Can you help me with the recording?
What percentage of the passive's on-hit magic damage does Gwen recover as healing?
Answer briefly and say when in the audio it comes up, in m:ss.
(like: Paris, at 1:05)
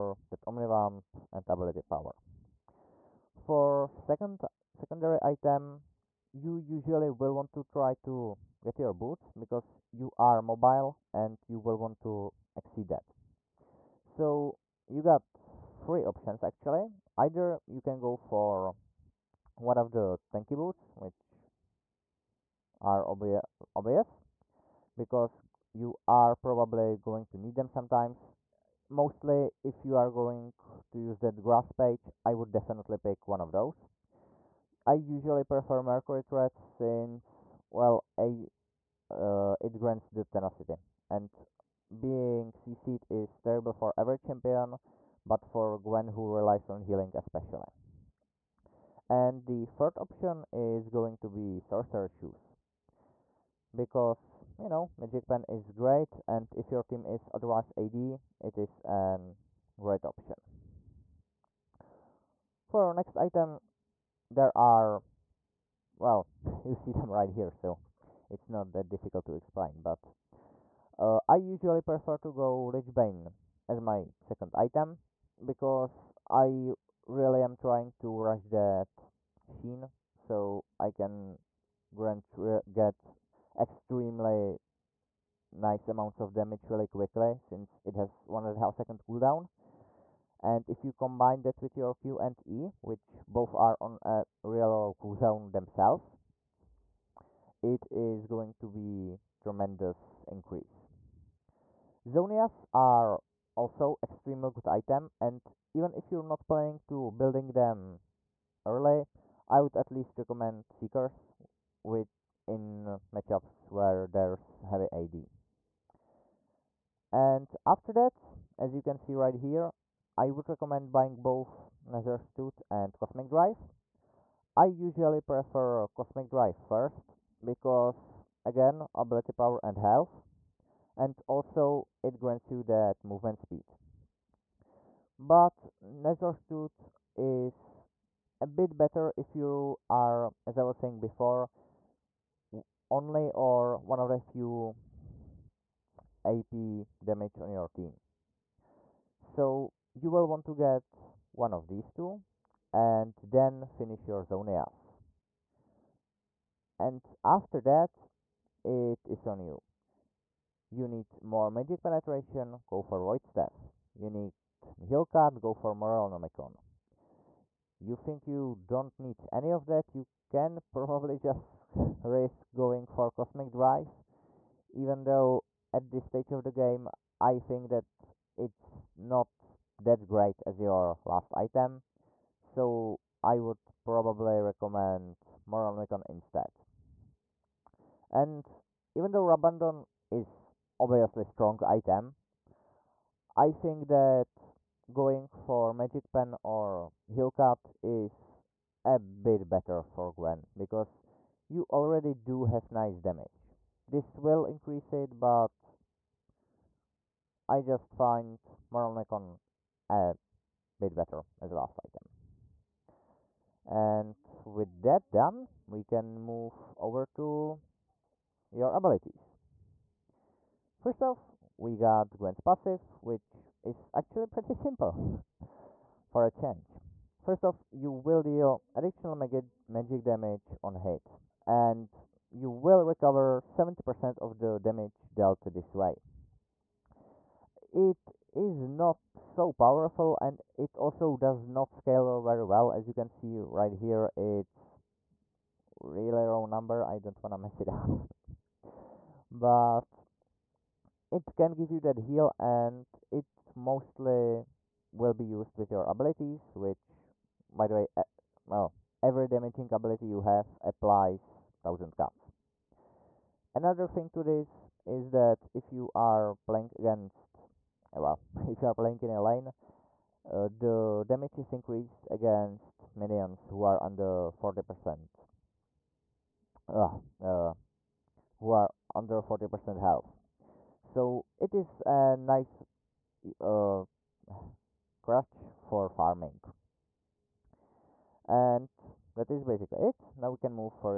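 70%, at 3:53.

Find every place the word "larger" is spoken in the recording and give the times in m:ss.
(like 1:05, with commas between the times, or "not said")
not said.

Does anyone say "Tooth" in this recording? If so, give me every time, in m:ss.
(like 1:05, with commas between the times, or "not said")
2:02, 2:16.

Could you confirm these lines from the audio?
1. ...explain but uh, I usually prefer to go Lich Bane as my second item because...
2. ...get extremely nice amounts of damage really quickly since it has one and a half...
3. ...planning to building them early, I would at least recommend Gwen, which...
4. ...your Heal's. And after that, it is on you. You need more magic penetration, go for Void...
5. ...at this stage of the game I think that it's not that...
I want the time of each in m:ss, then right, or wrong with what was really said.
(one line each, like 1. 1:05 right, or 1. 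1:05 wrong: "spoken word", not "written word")
1. 1:09 right
2. 1:22 right
3. 1:46 wrong: "Seekers", not "Gwen"
4. 2:34 wrong: "Zhonya", not "Heal"
5. 2:55 right.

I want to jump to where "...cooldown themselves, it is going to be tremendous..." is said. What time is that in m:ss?
1:35.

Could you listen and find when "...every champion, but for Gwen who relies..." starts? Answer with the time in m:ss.
0:43.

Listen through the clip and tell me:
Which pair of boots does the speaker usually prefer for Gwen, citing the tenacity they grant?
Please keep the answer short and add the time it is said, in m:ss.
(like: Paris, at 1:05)
Mercury Threads, at 0:35.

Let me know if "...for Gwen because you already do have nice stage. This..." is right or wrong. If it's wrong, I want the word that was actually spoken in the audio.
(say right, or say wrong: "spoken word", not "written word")
wrong: "damage", not "stage".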